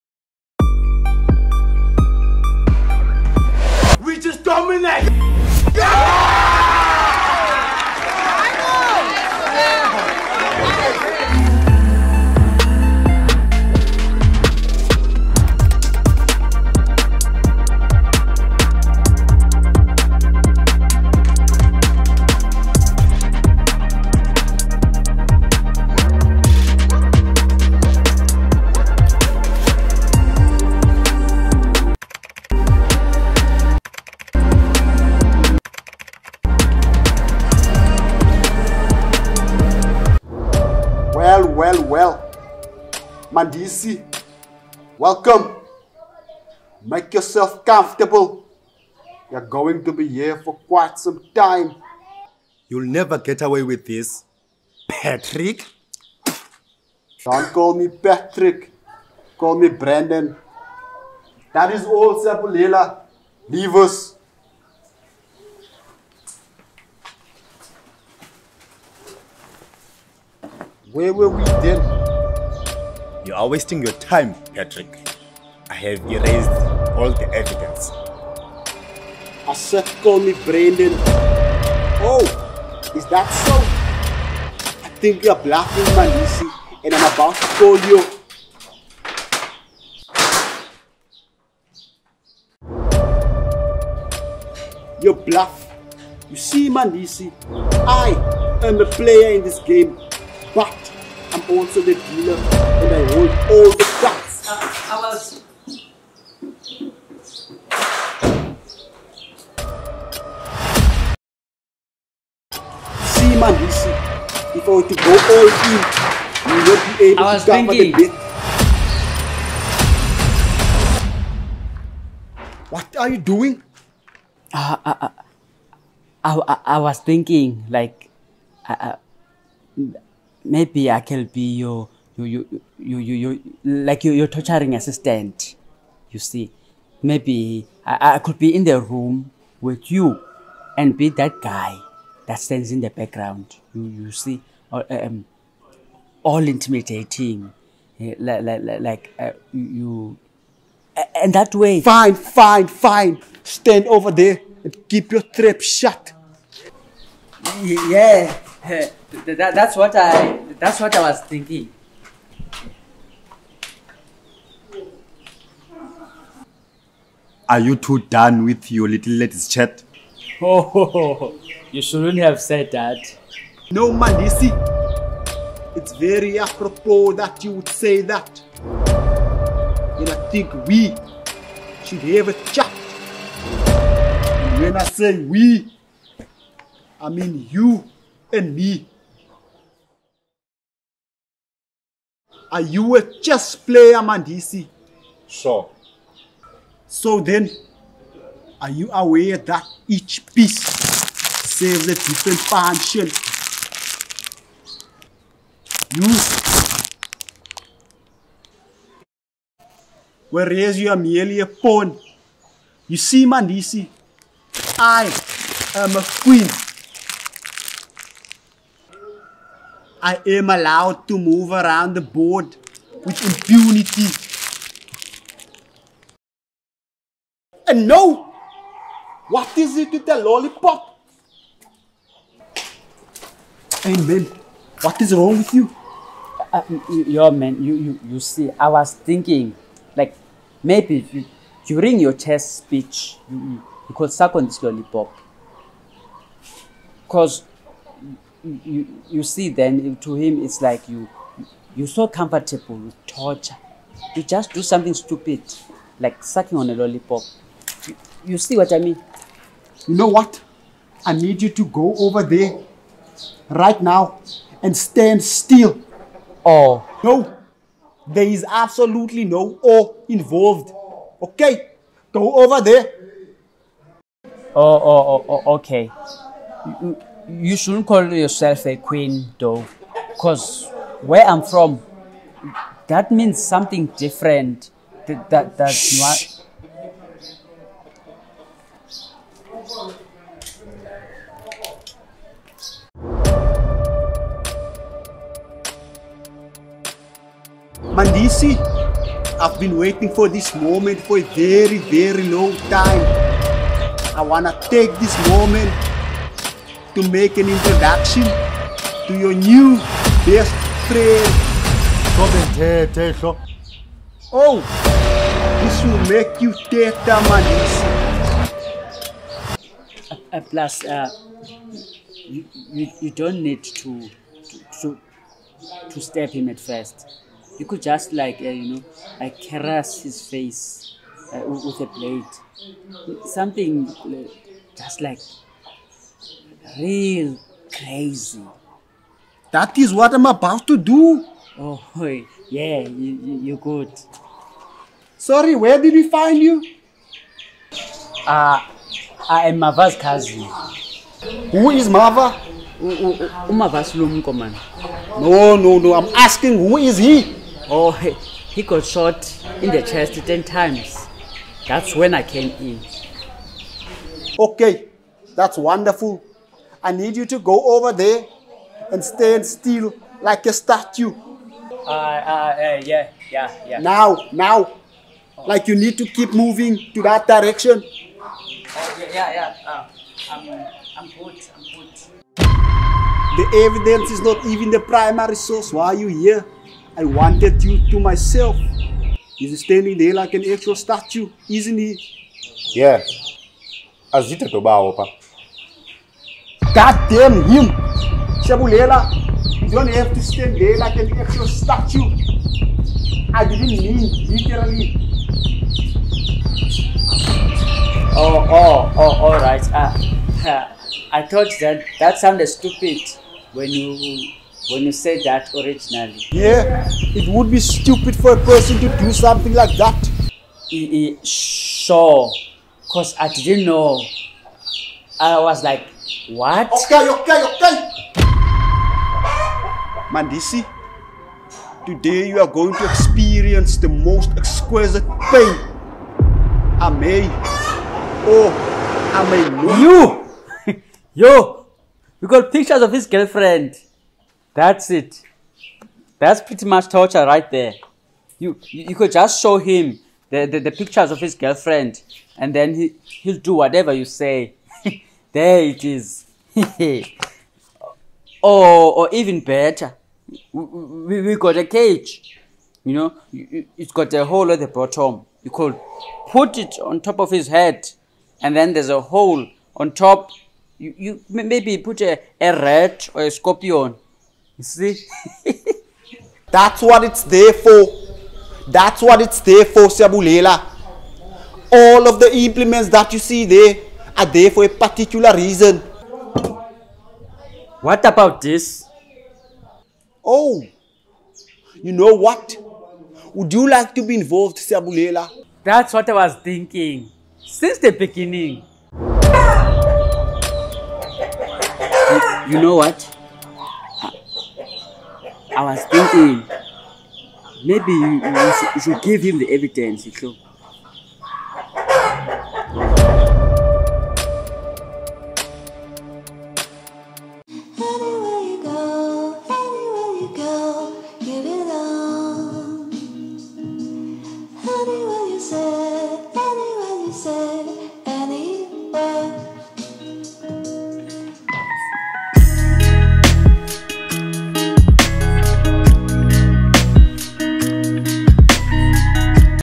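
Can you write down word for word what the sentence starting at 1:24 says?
I think you're bluffing, Mandisi, and I'm about to call you.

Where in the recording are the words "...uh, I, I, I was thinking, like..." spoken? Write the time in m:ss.
2:05.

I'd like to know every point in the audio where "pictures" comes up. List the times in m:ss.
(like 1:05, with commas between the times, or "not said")
7:22, 7:30.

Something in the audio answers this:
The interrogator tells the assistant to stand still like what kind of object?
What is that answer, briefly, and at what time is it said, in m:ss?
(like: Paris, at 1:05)
A statue, at 6:10.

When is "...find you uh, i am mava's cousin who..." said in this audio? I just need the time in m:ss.
5:46.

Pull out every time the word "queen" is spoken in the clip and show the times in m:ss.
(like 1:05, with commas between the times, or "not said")
3:36, 4:38.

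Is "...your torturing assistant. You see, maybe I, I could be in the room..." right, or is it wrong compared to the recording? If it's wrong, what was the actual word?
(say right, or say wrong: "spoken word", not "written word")
right.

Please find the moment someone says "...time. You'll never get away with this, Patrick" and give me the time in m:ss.
0:51.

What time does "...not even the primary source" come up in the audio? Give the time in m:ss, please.
6:24.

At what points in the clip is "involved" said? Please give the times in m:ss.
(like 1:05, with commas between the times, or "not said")
4:30, 8:14.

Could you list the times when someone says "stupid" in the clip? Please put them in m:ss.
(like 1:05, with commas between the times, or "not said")
4:14, 6:52, 6:57.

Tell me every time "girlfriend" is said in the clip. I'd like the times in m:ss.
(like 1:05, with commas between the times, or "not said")
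7:23, 7:31.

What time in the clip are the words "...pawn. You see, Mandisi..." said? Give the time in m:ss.
3:31.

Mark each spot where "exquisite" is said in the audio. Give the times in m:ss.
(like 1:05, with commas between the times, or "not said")
7:14.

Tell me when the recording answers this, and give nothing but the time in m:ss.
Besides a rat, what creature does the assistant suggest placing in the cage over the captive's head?
7:53.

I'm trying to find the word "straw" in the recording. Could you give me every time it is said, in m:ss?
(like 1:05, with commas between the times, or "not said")
not said.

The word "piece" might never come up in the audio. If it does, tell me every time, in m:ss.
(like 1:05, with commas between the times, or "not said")
3:20.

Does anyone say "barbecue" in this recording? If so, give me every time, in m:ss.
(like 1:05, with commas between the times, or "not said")
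not said.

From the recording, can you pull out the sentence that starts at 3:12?
Are you a chess player, Mandisi?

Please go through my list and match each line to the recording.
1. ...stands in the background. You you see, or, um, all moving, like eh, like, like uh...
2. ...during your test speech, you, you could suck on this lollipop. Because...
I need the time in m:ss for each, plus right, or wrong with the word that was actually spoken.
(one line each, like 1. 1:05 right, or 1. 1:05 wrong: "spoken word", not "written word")
1. 2:22 wrong: "intimidating", not "moving"
2. 4:01 right.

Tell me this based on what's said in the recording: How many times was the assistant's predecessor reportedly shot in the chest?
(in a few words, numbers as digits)
10.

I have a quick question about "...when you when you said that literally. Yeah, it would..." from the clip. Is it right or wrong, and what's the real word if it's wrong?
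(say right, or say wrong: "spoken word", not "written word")
wrong: "originally", not "literally".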